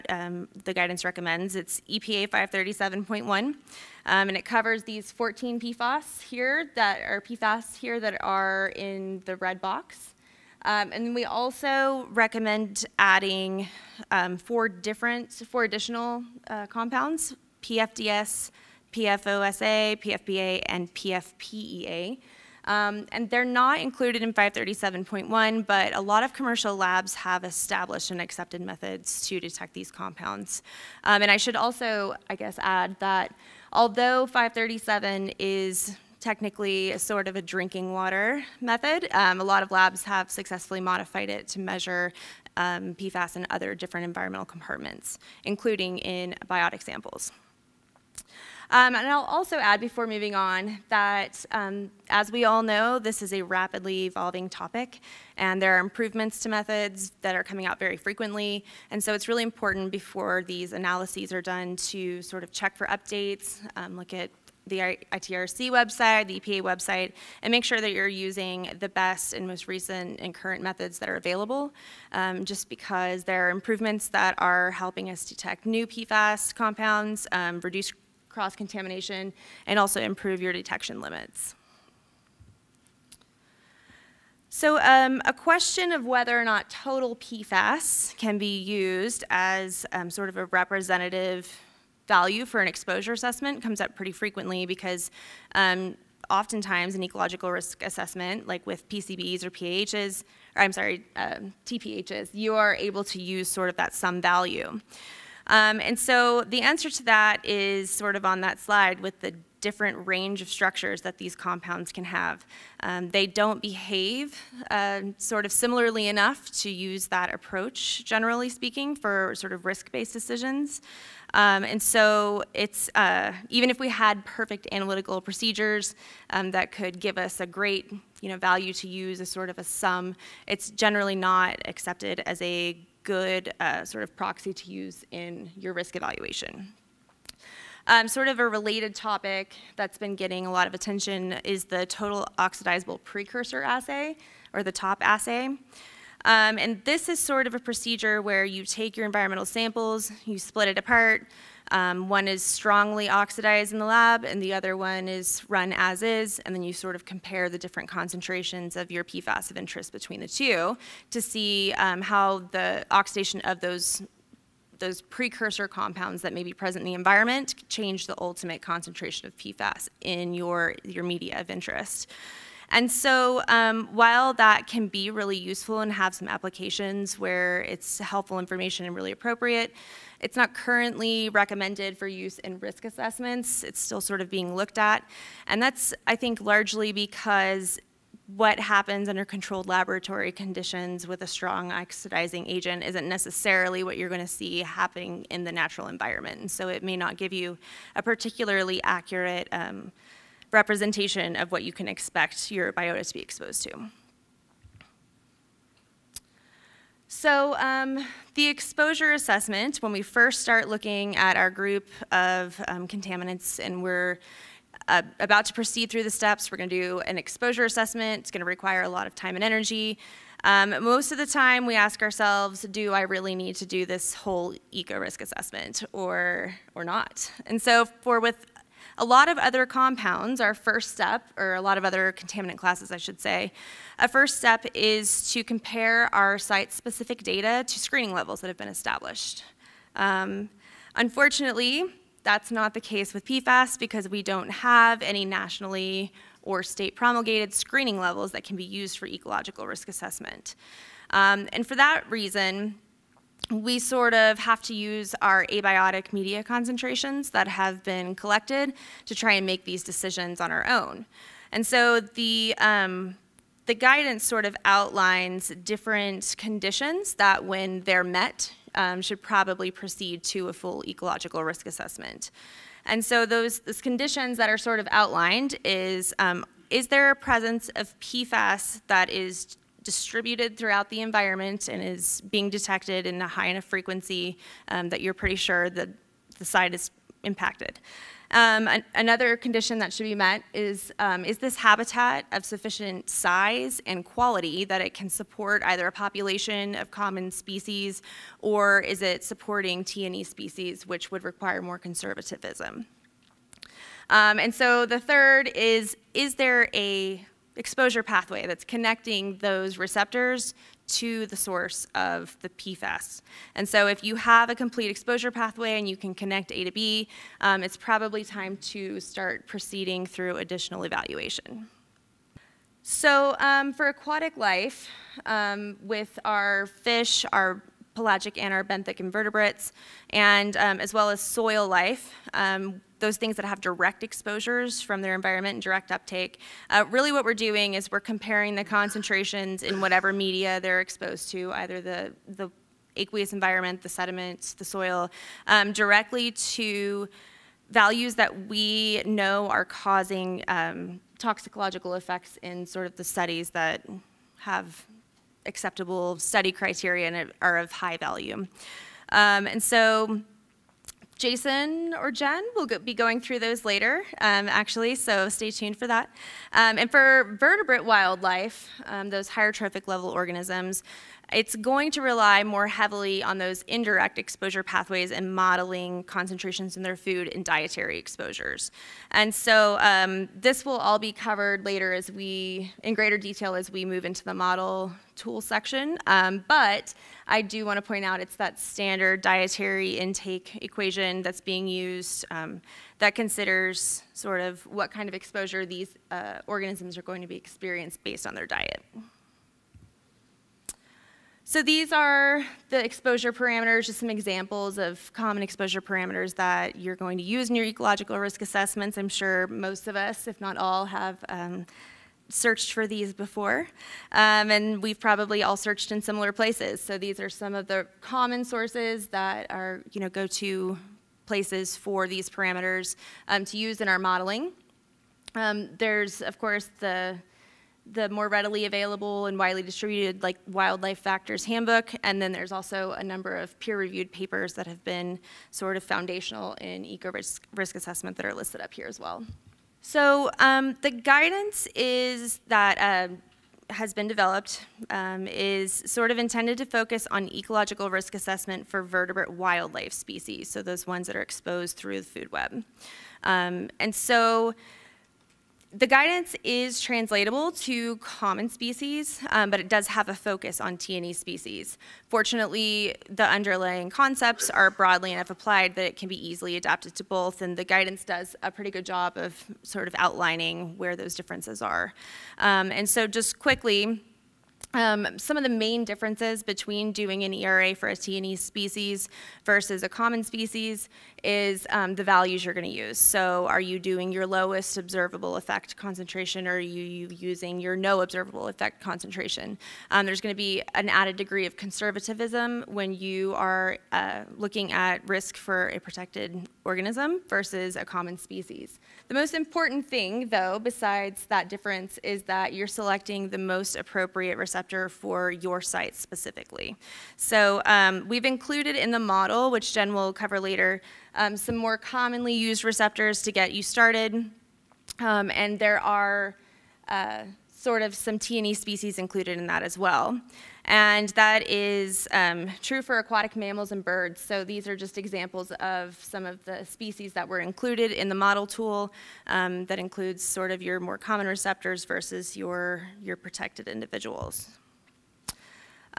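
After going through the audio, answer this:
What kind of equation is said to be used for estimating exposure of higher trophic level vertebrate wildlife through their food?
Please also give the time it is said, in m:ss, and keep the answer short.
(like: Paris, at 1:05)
standard dietary intake equation, at 6:28.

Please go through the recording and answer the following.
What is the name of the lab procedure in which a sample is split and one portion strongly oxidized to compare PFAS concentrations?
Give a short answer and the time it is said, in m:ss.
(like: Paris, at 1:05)
total oxidizable precursor assay, at 2:21.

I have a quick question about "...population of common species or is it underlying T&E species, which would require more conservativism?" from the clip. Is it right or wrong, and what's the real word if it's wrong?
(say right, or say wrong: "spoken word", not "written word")
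wrong: "supporting", not "underlying".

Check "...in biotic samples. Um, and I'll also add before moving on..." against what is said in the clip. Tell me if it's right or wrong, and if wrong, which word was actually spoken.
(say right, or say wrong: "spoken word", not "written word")
right.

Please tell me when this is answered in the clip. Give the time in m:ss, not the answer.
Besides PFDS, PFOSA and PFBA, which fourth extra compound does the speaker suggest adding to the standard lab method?
0:20.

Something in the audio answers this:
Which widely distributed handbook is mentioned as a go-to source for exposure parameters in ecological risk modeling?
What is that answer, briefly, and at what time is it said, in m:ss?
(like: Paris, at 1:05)
Wildlife Factors Handbook, at 7:10.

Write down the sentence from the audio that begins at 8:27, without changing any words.
So um, we've included in the model, which Jen will cover later, um, some more commonly used receptors to get you started.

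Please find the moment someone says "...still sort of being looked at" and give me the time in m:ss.
3:03.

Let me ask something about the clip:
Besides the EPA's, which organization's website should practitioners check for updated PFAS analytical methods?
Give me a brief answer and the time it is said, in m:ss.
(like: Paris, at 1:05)
ITRC, at 1:05.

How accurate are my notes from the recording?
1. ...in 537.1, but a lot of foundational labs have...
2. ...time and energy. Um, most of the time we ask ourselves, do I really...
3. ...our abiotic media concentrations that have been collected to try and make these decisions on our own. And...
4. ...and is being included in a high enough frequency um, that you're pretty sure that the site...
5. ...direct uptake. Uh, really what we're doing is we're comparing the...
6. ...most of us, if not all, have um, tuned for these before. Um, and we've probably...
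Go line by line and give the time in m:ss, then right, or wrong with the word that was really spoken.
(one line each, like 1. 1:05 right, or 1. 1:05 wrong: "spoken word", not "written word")
1. 0:24 wrong: "commercial", not "foundational"
2. 3:39 right
3. 4:15 right
4. 4:41 wrong: "detected", not "included"
5. 5:35 right
6. 6:49 wrong: "searched", not "tuned".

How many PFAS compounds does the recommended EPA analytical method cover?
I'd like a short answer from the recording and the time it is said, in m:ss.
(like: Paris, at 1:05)
14, at 0:05.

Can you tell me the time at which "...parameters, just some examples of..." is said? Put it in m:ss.
6:43.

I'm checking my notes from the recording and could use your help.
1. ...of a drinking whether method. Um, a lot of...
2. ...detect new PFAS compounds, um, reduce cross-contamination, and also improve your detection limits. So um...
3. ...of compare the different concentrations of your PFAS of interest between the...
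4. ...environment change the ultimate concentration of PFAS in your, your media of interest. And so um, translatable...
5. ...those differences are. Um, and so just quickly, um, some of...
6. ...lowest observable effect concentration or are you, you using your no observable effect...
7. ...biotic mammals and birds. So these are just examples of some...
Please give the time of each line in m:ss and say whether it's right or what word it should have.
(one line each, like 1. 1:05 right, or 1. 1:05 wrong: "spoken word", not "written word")
1. 0:37 wrong: "water", not "whether"
2. 1:15 right
3. 2:36 right
4. 2:46 wrong: "while", not "translatable"
5. 7:50 right
6. 8:04 right
7. 8:42 wrong: "aquatic", not "biotic".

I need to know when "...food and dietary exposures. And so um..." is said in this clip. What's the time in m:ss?
6:16.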